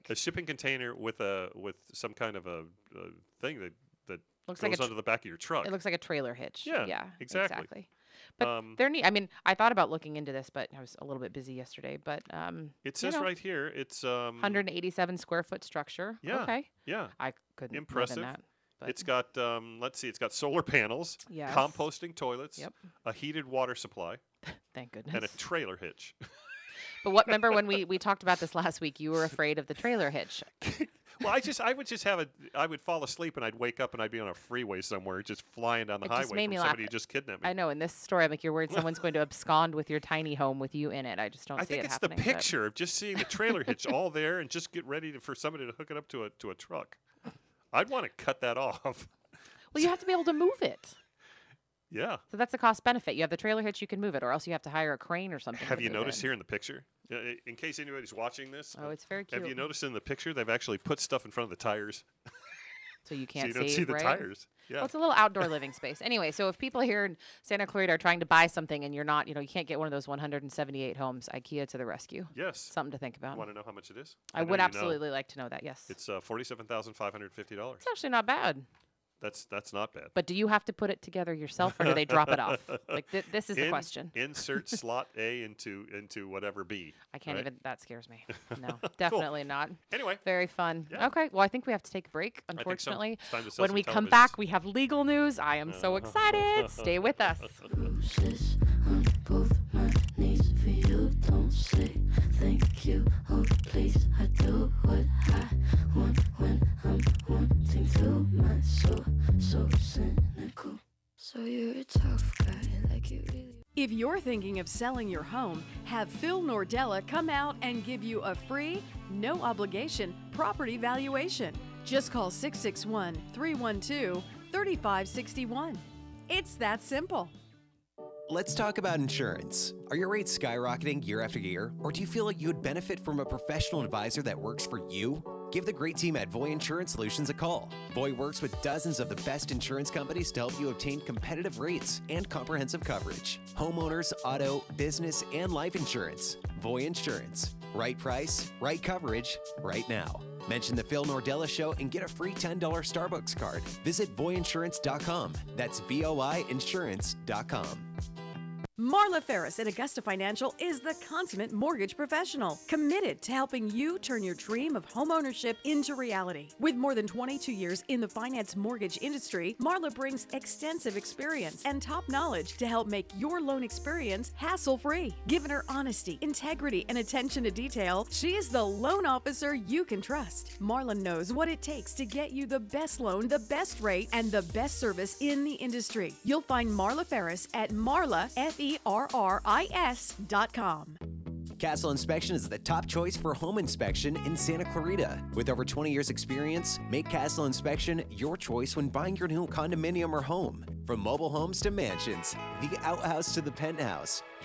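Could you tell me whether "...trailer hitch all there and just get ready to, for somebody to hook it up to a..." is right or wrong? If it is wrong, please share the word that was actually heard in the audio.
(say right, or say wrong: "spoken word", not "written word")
right.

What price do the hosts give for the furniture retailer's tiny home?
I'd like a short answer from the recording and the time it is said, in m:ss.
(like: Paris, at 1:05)
$47,550, at 1:16.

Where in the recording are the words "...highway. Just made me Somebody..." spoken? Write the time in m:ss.
0:36.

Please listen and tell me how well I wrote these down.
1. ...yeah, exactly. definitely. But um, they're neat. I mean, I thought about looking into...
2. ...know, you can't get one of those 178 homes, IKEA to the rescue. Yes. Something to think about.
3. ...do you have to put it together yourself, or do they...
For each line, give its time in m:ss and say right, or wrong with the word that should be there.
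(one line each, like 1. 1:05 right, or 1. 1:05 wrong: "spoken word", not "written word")
1. 0:06 wrong: "exactly", not "definitely"
2. 1:09 right
3. 1:20 right.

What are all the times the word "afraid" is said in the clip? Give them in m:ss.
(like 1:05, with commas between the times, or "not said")
0:29.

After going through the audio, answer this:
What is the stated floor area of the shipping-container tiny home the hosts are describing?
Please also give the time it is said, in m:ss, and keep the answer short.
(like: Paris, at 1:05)
187 square feet, at 0:14.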